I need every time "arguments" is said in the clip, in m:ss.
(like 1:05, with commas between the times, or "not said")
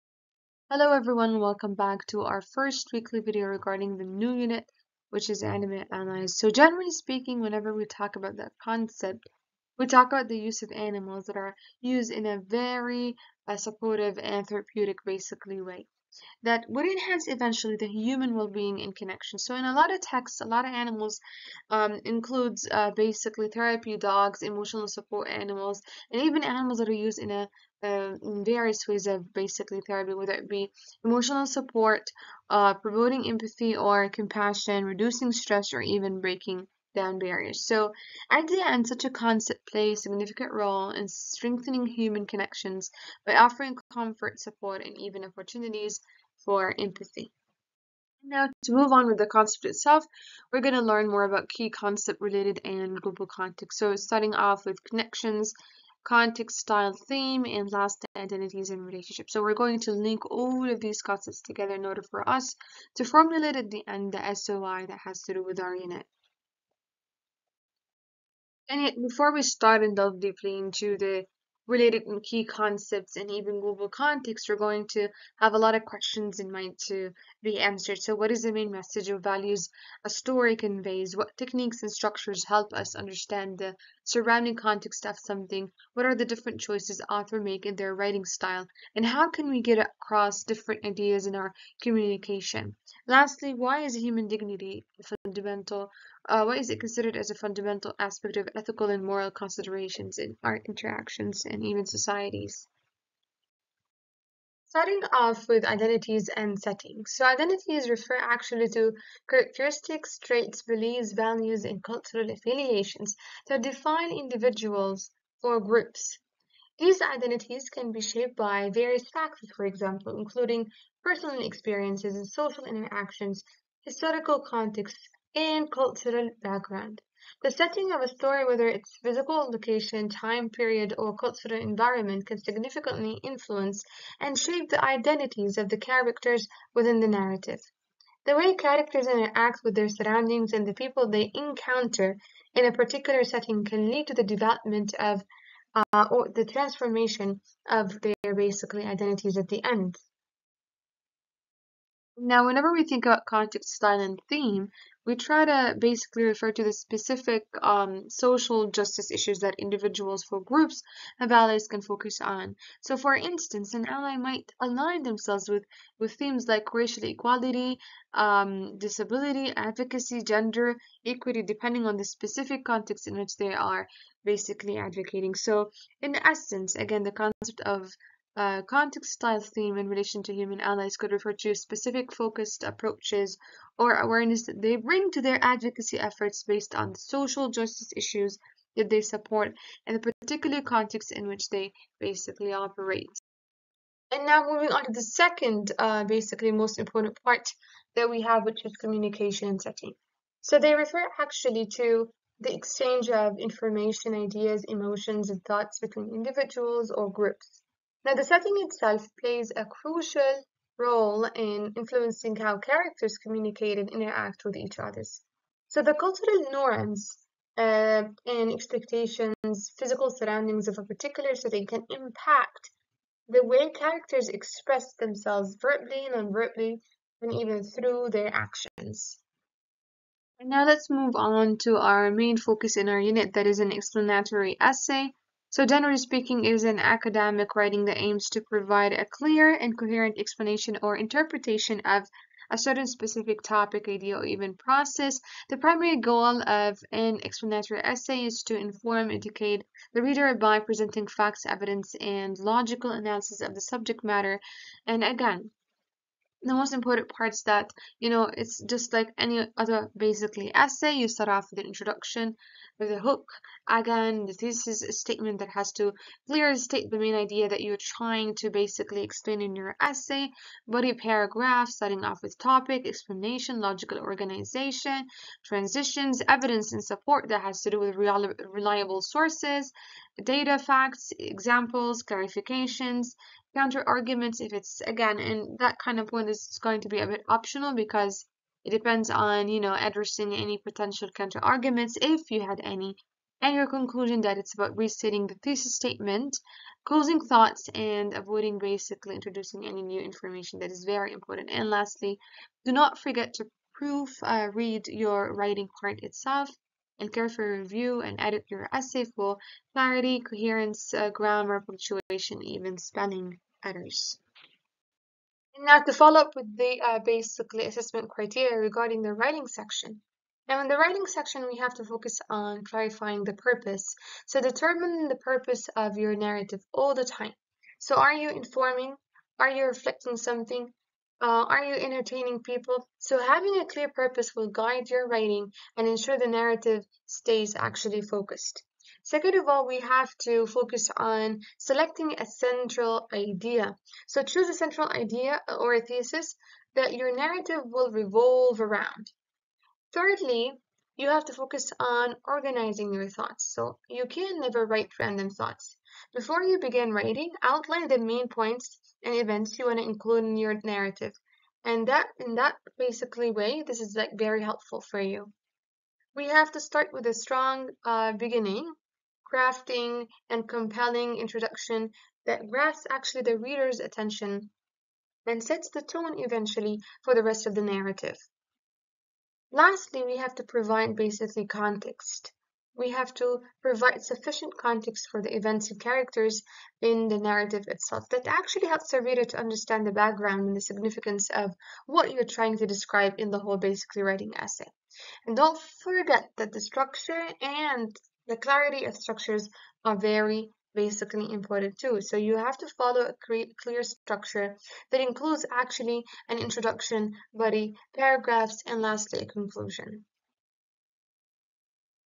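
4:43, 4:51.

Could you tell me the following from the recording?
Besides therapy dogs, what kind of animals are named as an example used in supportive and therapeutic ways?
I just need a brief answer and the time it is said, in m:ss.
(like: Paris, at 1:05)
Emotional support animals, at 0:24.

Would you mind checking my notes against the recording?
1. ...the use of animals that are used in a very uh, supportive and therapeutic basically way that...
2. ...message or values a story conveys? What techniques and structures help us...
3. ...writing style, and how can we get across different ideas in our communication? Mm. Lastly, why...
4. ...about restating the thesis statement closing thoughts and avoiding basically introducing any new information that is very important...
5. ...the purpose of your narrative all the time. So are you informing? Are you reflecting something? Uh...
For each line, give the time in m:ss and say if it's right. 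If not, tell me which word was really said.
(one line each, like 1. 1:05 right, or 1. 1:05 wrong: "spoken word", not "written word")
1. 0:10 right
2. 1:18 right
3. 1:27 right
4. 4:54 right
5. 5:25 right.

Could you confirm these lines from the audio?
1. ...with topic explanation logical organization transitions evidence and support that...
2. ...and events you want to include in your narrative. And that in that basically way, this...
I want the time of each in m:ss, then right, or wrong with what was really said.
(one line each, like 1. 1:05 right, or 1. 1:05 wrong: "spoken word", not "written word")
1. 4:32 right
2. 5:59 right.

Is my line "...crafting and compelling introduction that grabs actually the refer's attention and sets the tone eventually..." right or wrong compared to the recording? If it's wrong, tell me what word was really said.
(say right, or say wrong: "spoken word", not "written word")
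wrong: "reader", not "refer".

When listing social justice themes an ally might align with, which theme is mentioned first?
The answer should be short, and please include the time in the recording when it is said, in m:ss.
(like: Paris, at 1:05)
Racial equality, at 2:46.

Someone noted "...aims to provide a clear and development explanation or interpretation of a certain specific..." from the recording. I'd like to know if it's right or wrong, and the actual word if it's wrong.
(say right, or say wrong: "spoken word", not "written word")
wrong: "coherent", not "development".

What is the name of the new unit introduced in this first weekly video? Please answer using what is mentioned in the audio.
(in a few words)
Animal allies.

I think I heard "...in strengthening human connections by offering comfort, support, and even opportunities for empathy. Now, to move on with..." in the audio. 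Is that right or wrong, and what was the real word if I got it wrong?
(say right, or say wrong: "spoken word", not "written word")
right.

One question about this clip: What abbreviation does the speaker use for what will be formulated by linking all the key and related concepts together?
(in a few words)
SOI.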